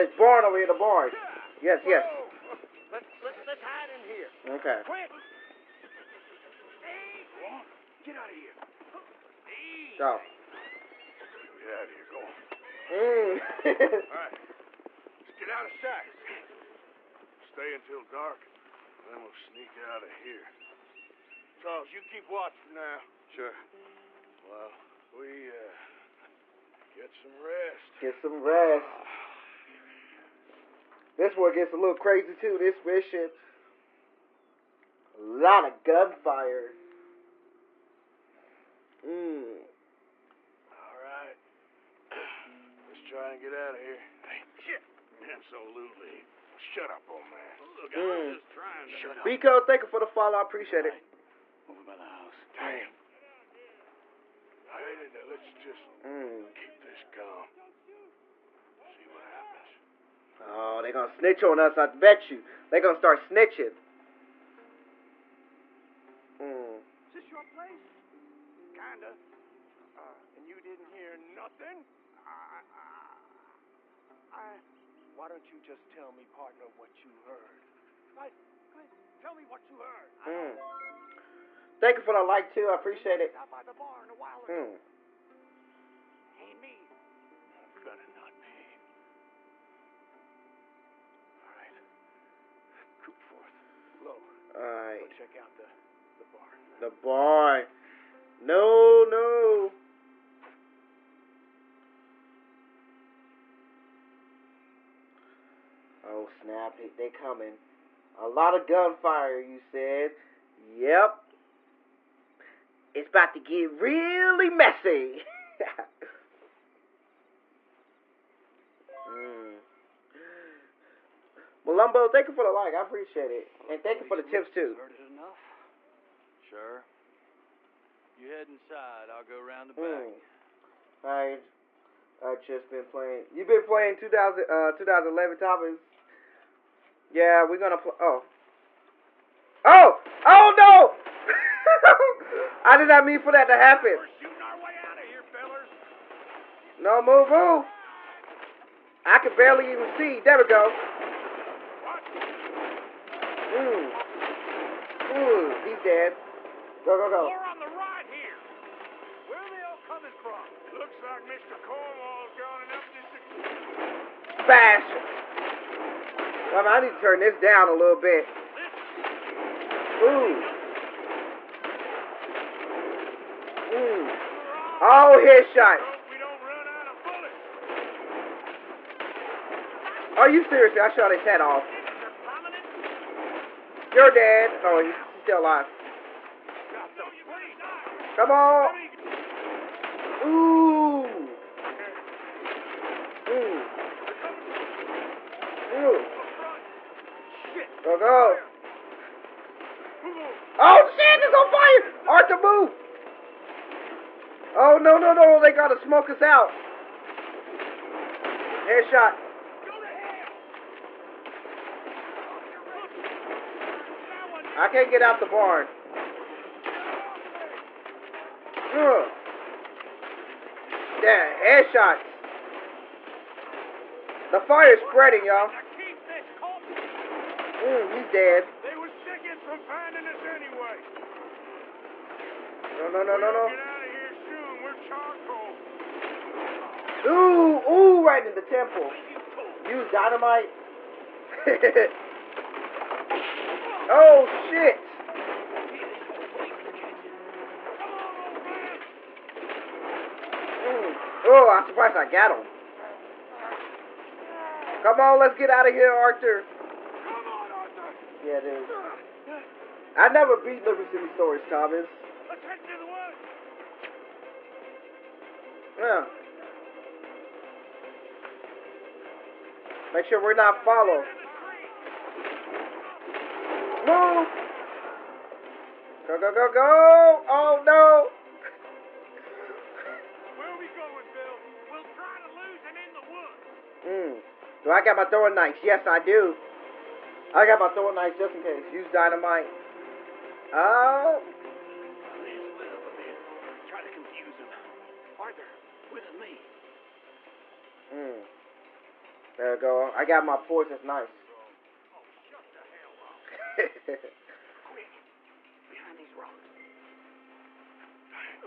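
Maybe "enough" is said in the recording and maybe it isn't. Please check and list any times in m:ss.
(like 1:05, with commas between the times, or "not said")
2:05, 2:42.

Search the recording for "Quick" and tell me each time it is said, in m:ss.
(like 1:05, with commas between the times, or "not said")
0:04, 5:04.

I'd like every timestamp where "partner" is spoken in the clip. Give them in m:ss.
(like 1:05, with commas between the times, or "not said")
1:16.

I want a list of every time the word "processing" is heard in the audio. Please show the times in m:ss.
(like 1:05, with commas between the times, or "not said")
not said.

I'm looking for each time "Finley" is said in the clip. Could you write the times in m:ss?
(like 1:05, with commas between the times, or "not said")
not said.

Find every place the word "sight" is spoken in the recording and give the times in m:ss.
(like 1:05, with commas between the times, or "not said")
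0:15.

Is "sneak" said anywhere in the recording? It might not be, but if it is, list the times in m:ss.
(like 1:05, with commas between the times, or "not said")
0:19.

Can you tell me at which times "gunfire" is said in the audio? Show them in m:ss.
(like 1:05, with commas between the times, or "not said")
0:35, 1:48.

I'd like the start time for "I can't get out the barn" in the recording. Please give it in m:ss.
3:34.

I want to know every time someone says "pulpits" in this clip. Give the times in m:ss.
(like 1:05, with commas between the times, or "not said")
not said.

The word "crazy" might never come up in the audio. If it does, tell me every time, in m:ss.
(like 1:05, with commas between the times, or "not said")
0:31.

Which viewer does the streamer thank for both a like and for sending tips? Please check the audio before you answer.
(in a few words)
Malumbo.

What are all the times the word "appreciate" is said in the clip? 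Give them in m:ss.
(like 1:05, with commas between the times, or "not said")
0:50, 1:22, 2:02.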